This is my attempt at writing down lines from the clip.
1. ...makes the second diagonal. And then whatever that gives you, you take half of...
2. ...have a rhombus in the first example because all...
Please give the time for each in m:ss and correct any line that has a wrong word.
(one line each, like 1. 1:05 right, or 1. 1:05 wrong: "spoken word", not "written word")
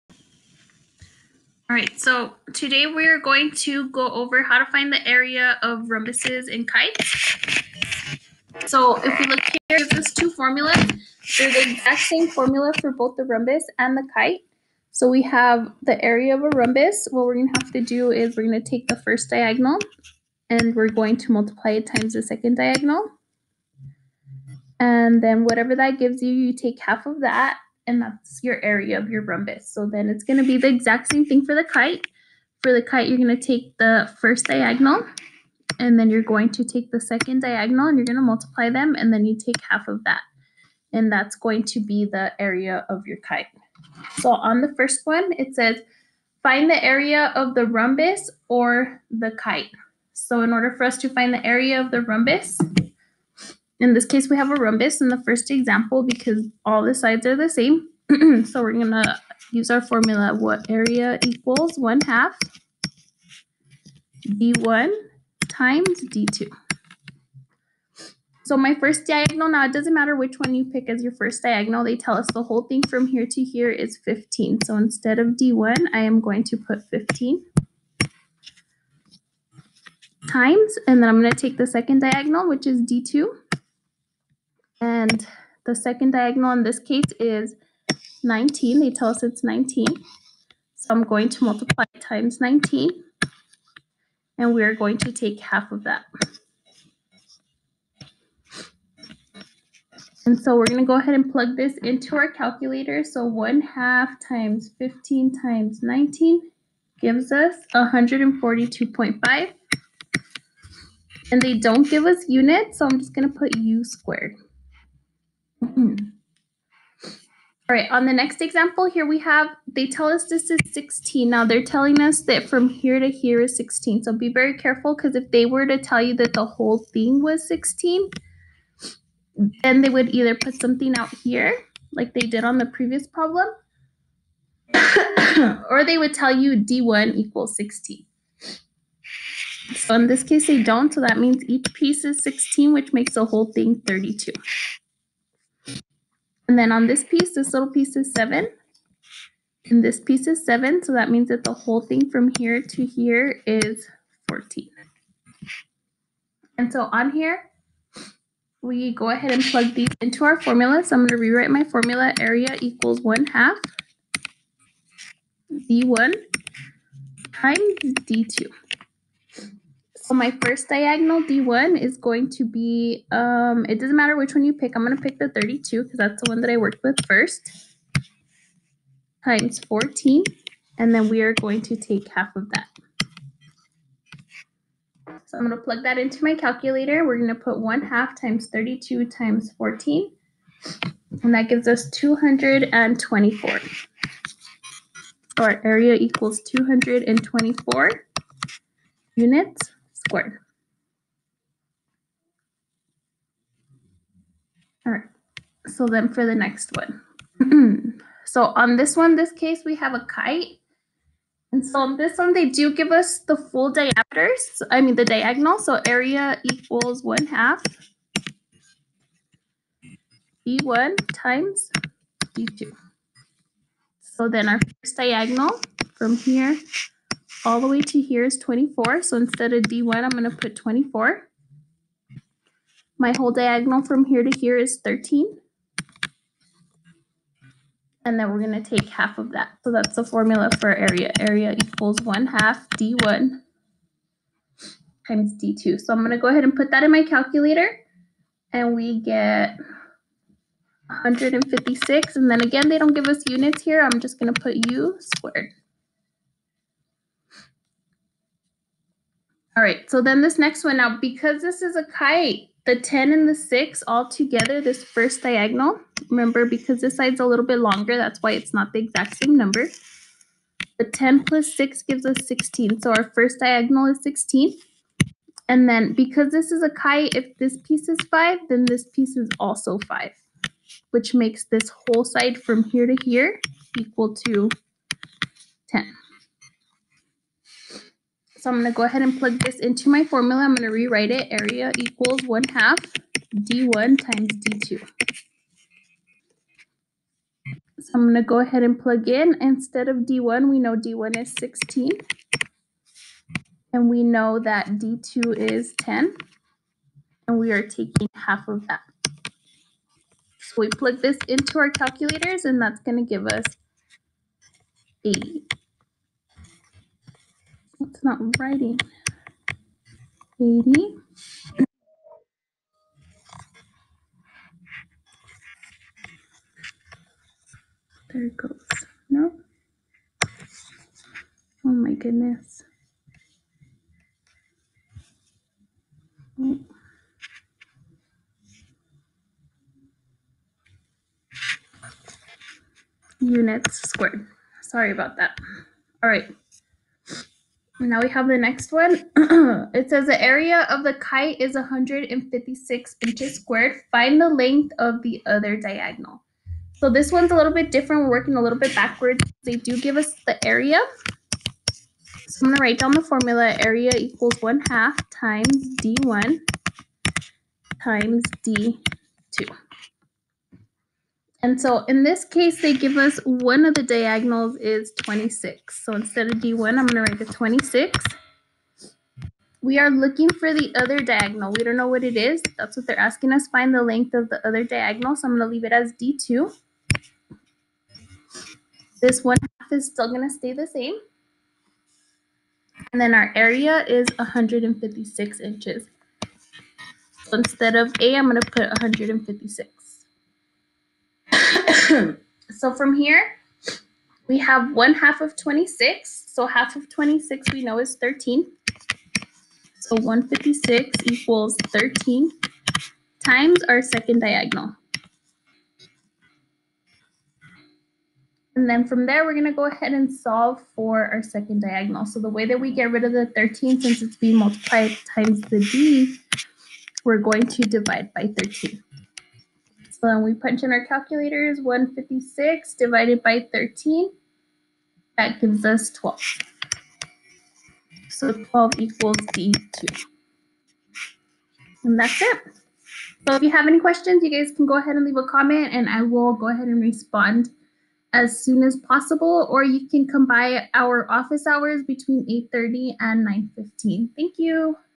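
1. 0:21 wrong: "times", not "makes"
2. 0:54 right.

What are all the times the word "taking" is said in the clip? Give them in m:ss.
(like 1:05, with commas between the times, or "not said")
5:07.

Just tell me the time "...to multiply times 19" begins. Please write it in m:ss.
1:31.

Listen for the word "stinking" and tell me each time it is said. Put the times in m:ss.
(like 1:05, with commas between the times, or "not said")
not said.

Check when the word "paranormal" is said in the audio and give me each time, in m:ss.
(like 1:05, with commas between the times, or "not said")
not said.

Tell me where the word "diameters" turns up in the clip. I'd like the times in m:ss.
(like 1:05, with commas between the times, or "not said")
3:33.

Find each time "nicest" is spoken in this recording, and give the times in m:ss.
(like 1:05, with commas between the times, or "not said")
not said.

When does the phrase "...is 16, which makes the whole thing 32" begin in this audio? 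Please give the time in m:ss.
2:22.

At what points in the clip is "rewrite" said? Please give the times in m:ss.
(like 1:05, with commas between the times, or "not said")
2:41, 4:50.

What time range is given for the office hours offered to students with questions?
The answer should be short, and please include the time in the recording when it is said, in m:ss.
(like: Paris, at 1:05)
8:30 to 9:15, at 7:31.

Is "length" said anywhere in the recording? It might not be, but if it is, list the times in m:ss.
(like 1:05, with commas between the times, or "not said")
5:54, 6:23.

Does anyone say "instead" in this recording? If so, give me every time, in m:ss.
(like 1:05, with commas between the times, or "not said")
1:14, 3:49, 4:59, 6:15, 6:37.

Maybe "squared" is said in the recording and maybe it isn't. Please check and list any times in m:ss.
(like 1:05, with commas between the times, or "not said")
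1:53, 4:14, 5:43, 5:53.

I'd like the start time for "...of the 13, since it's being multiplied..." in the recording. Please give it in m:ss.
7:03.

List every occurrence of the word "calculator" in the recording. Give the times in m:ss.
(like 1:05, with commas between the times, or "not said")
1:42, 3:06, 4:07, 5:11, 7:10.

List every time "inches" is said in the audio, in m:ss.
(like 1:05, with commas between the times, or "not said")
5:53, 6:35.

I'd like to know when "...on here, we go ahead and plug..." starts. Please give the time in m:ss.
2:36.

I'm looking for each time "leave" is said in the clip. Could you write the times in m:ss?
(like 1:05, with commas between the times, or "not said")
6:25, 7:25.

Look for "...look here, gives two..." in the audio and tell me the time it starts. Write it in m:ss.
0:09.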